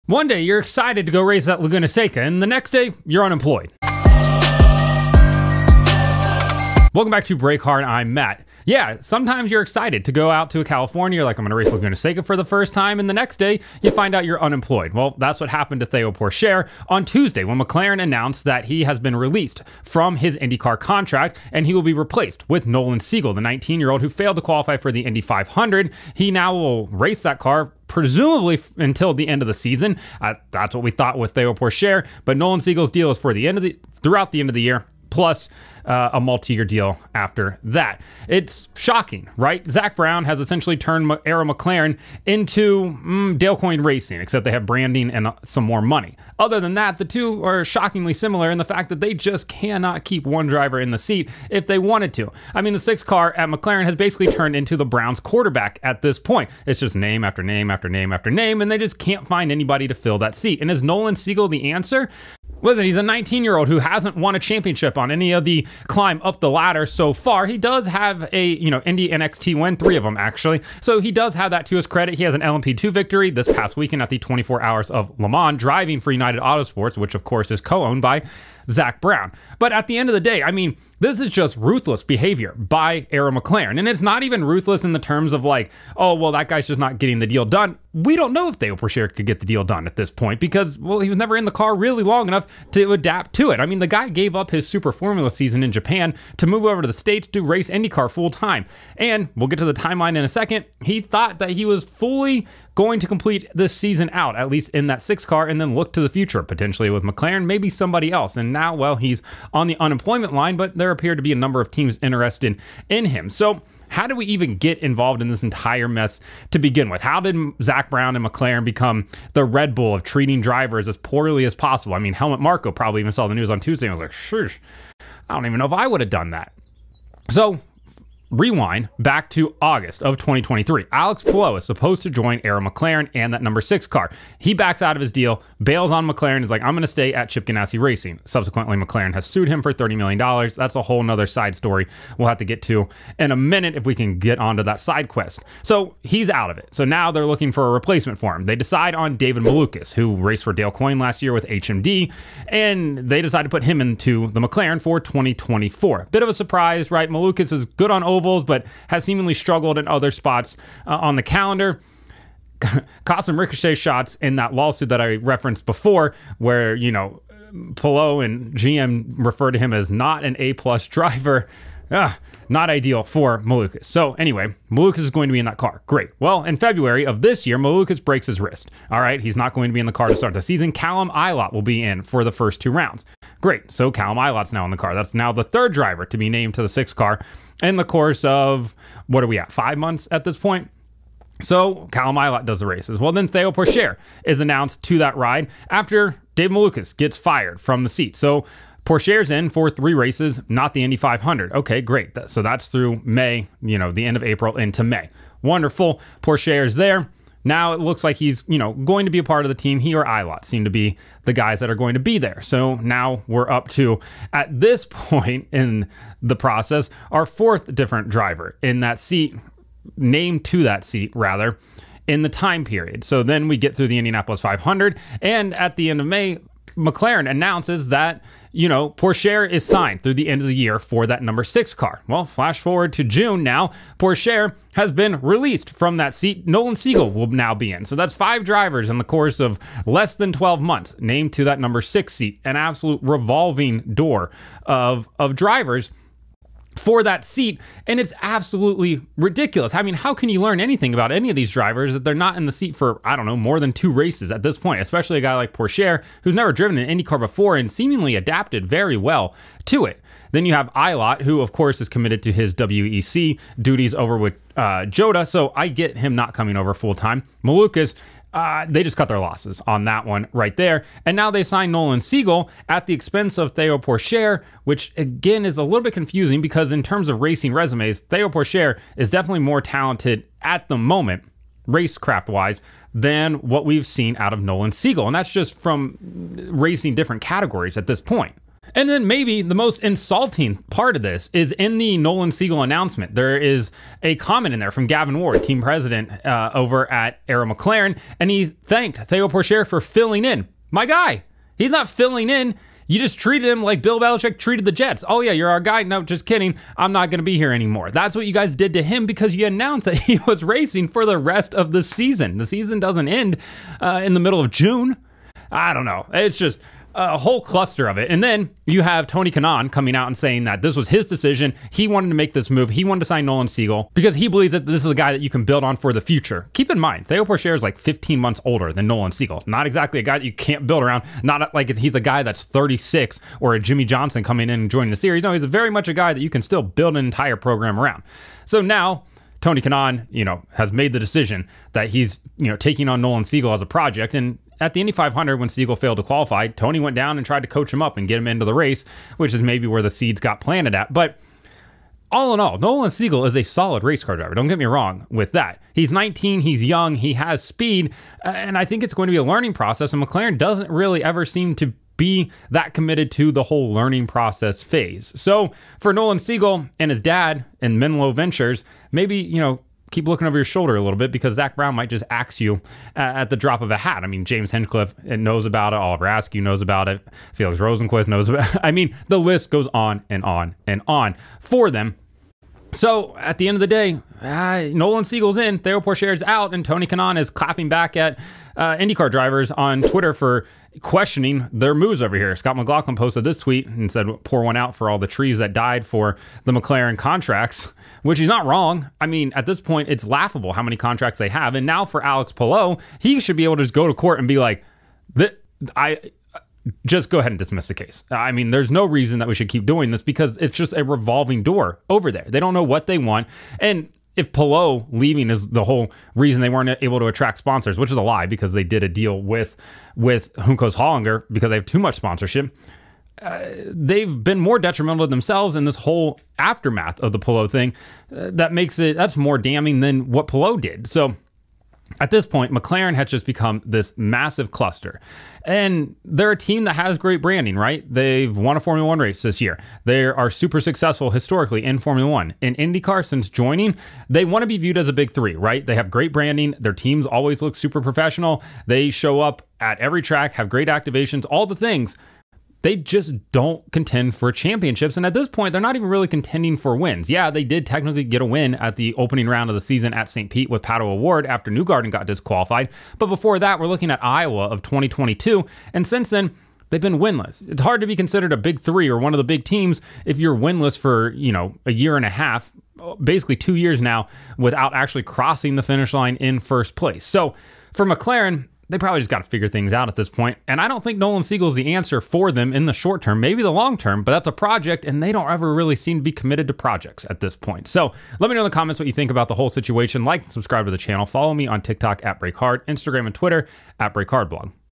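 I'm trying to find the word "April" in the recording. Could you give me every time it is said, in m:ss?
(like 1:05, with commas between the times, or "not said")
3:24.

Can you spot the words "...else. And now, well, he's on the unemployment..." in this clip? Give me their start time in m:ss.
1:48.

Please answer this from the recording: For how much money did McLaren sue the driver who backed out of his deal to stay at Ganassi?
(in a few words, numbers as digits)
$30 million.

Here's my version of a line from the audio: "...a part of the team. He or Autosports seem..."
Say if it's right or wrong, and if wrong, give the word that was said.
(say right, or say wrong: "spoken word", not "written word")
wrong: "Ilott", not "Autosports".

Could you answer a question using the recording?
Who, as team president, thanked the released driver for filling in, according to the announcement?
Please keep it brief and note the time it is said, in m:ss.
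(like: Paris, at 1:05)
Gavin Ward, at 4:54.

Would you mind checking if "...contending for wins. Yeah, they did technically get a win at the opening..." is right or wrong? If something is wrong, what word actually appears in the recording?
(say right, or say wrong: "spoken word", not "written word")
right.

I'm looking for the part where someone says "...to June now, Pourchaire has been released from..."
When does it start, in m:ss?
3:52.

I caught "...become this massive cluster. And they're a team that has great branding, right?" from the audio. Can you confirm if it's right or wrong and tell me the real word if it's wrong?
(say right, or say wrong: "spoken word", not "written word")
right.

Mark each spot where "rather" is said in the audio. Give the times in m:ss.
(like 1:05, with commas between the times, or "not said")
3:41.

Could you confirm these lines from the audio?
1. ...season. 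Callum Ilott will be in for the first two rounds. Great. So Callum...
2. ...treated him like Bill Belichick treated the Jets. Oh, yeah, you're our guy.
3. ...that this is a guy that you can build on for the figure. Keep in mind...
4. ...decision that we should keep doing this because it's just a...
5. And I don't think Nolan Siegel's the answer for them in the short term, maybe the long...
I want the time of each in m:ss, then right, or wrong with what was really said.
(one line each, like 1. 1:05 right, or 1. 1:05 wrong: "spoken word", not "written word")
1. 3:00 right
2. 5:03 right
3. 5:24 wrong: "future", not "figure"
4. 6:48 wrong: "reason", not "decision"
5. 8:00 right.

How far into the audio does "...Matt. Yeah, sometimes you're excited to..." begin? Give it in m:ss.
0:08.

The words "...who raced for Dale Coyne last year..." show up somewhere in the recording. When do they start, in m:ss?
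2:29.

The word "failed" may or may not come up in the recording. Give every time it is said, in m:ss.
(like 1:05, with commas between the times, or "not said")
0:24, 5:45.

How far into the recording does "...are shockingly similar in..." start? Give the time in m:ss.
0:47.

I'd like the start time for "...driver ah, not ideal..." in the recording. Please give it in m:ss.
2:50.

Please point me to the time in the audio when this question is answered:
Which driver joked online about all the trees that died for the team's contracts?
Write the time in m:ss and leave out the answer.
6:32.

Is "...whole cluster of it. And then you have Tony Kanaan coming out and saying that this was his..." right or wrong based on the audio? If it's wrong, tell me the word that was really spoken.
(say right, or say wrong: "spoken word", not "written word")
right.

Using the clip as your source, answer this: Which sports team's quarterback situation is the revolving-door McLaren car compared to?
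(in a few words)
The Browns.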